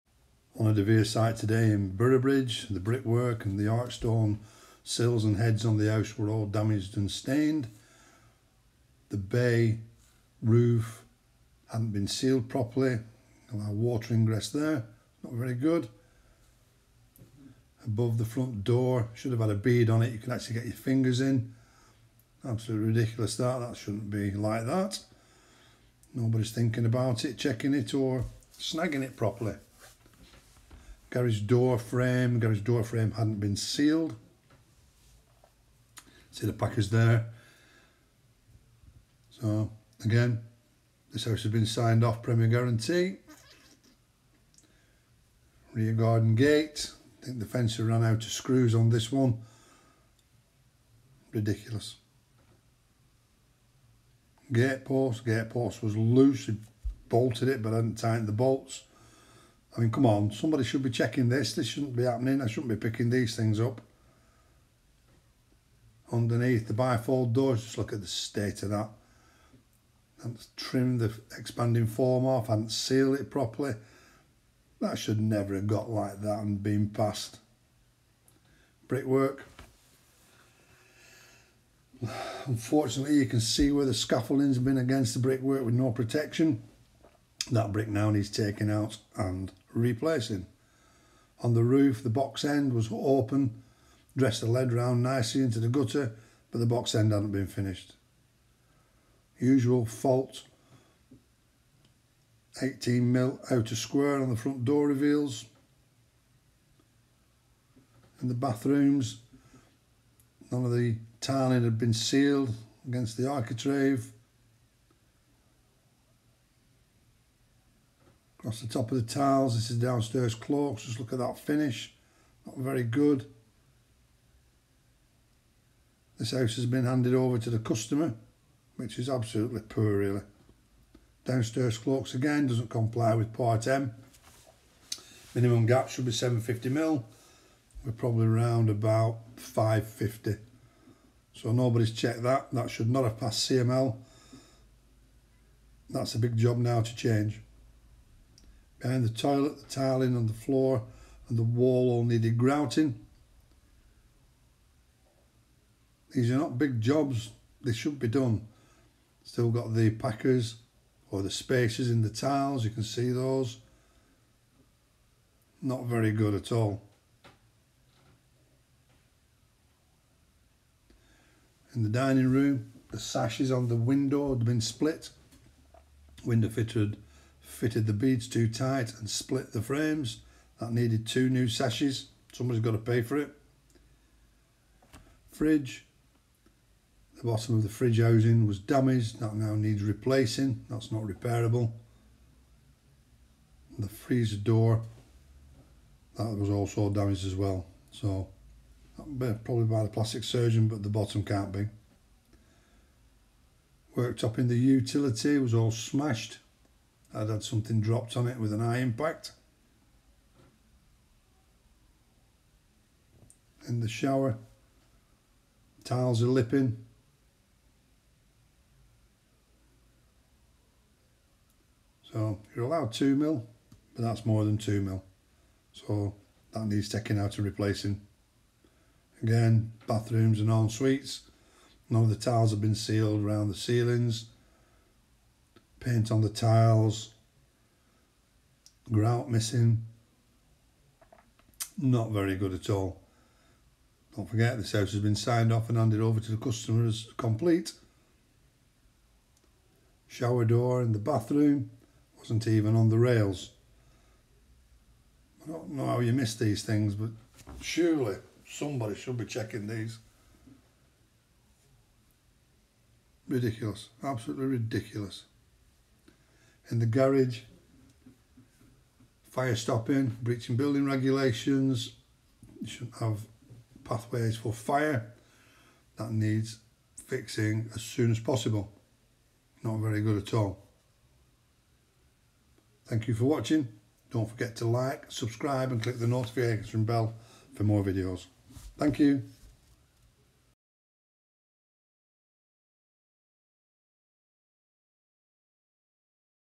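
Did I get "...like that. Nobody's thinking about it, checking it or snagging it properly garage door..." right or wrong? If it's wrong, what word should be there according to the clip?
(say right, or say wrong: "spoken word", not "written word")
right.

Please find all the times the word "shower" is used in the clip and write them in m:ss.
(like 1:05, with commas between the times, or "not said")
3:33, 4:10.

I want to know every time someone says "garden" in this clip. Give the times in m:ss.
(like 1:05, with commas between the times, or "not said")
0:45.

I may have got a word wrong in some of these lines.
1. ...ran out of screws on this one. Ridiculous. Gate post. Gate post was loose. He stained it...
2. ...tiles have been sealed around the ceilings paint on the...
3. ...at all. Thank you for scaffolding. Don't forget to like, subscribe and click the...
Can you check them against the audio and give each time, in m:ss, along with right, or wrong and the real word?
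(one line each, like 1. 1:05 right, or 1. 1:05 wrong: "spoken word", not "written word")
1. 0:47 wrong: "bolted", not "stained"
2. 3:52 right
3. 4:40 wrong: "watching", not "scaffolding".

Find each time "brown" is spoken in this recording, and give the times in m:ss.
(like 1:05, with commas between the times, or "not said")
not said.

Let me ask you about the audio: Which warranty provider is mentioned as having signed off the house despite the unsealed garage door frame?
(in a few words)
Premier Guarantee.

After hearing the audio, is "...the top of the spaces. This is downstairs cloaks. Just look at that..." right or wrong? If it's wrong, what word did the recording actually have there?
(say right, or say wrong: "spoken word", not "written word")
wrong: "tiles", not "spaces".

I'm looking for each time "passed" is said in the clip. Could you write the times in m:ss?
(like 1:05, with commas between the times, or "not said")
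1:16, 2:23.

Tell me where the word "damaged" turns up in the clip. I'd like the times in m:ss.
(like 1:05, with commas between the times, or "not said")
0:06, 3:08, 3:16.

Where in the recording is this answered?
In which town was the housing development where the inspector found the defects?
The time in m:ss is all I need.
0:01.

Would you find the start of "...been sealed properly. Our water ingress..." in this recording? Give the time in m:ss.
0:11.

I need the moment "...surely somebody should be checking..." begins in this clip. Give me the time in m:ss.
4:17.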